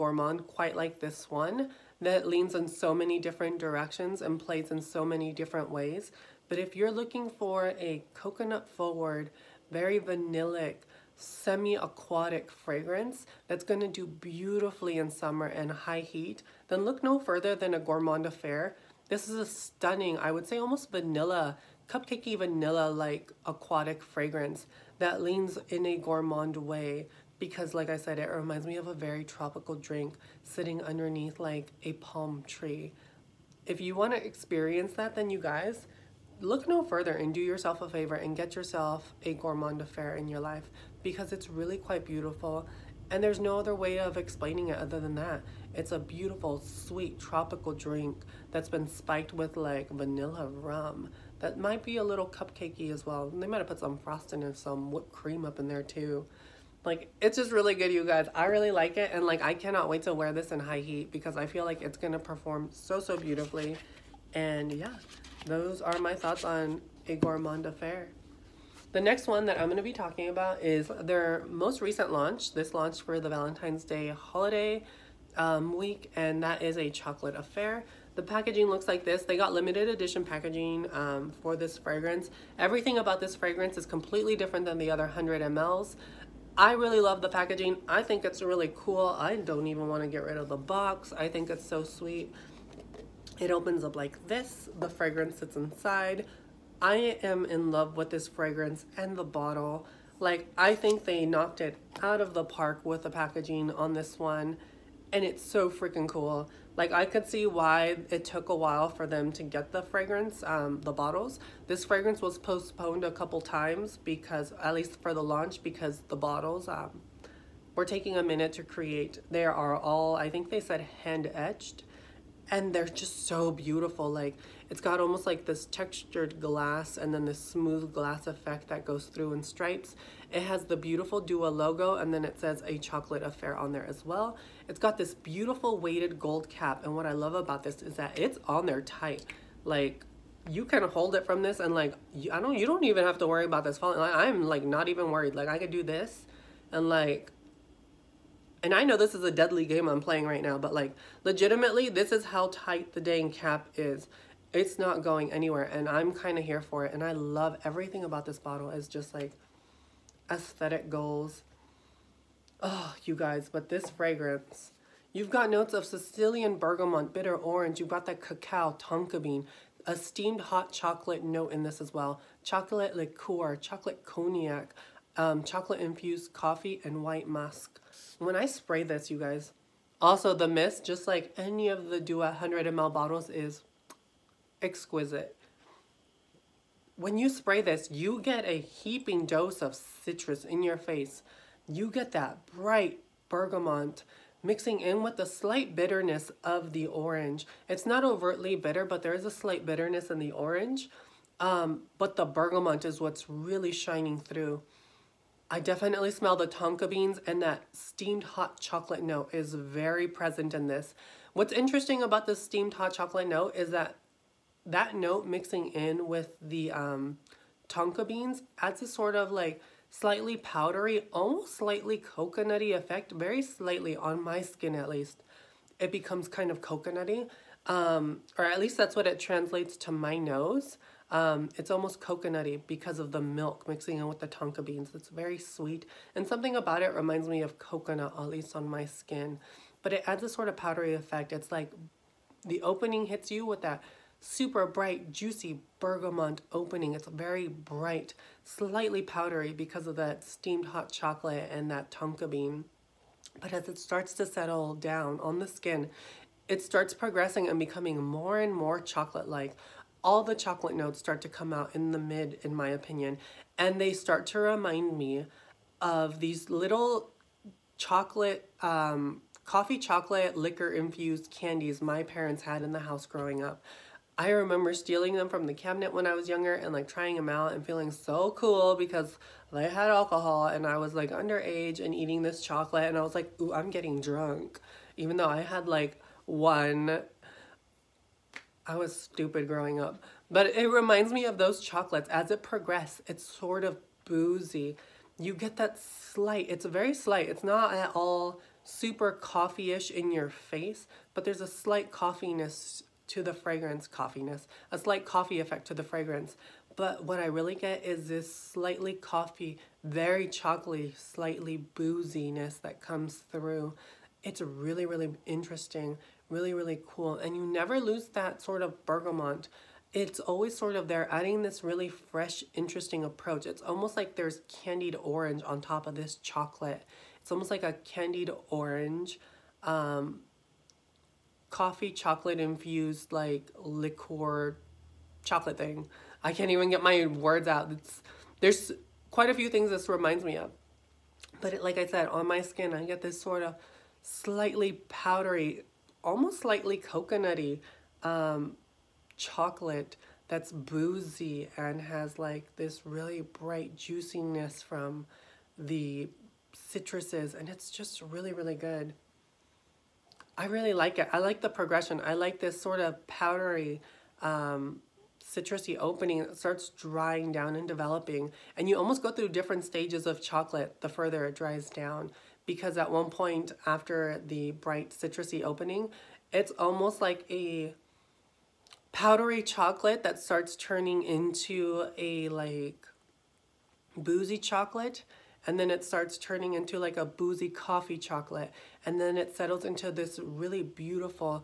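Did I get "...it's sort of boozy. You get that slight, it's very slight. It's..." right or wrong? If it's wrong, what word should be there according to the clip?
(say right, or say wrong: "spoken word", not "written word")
right.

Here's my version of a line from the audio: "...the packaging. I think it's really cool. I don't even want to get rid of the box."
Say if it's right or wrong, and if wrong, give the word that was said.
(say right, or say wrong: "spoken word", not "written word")
right.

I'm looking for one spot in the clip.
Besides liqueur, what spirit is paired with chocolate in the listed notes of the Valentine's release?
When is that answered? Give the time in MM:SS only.
02:53.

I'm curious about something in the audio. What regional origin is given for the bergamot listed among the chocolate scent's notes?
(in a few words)
Sicilian.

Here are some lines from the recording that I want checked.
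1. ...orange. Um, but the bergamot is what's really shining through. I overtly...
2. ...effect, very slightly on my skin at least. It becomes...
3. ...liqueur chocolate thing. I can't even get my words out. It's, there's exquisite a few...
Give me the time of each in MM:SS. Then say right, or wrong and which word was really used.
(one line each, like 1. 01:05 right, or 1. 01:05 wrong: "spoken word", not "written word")
1. 03:20 wrong: "definitely", not "overtly"
2. 03:42 right
3. 05:33 wrong: "quite", not "exquisite".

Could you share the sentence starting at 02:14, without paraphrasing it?
It's got this beautiful weighted gold cap and what I love about this is that it's on there tight.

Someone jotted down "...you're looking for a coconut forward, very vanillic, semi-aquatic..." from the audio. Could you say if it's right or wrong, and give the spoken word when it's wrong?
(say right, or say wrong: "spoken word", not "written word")
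right.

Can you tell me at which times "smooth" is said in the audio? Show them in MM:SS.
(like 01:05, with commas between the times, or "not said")
02:07.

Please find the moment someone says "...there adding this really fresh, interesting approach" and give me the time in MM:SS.
05:20.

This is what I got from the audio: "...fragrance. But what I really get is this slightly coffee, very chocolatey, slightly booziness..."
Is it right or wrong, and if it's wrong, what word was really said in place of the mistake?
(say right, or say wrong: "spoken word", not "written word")
right.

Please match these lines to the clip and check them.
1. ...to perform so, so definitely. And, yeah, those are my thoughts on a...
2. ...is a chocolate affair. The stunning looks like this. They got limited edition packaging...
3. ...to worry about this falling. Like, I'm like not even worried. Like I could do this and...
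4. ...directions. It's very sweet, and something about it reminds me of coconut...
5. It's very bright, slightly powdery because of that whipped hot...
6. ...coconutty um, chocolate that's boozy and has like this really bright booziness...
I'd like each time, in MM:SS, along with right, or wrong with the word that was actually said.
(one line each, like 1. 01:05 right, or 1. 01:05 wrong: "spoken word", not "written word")
1. 01:02 wrong: "beautifully", not "definitely"
2. 01:16 wrong: "packaging", not "stunning"
3. 02:23 right
4. 03:54 wrong: "beans", not "directions"
5. 04:06 wrong: "steamed", not "whipped"
6. 05:46 wrong: "juiciness", not "booziness".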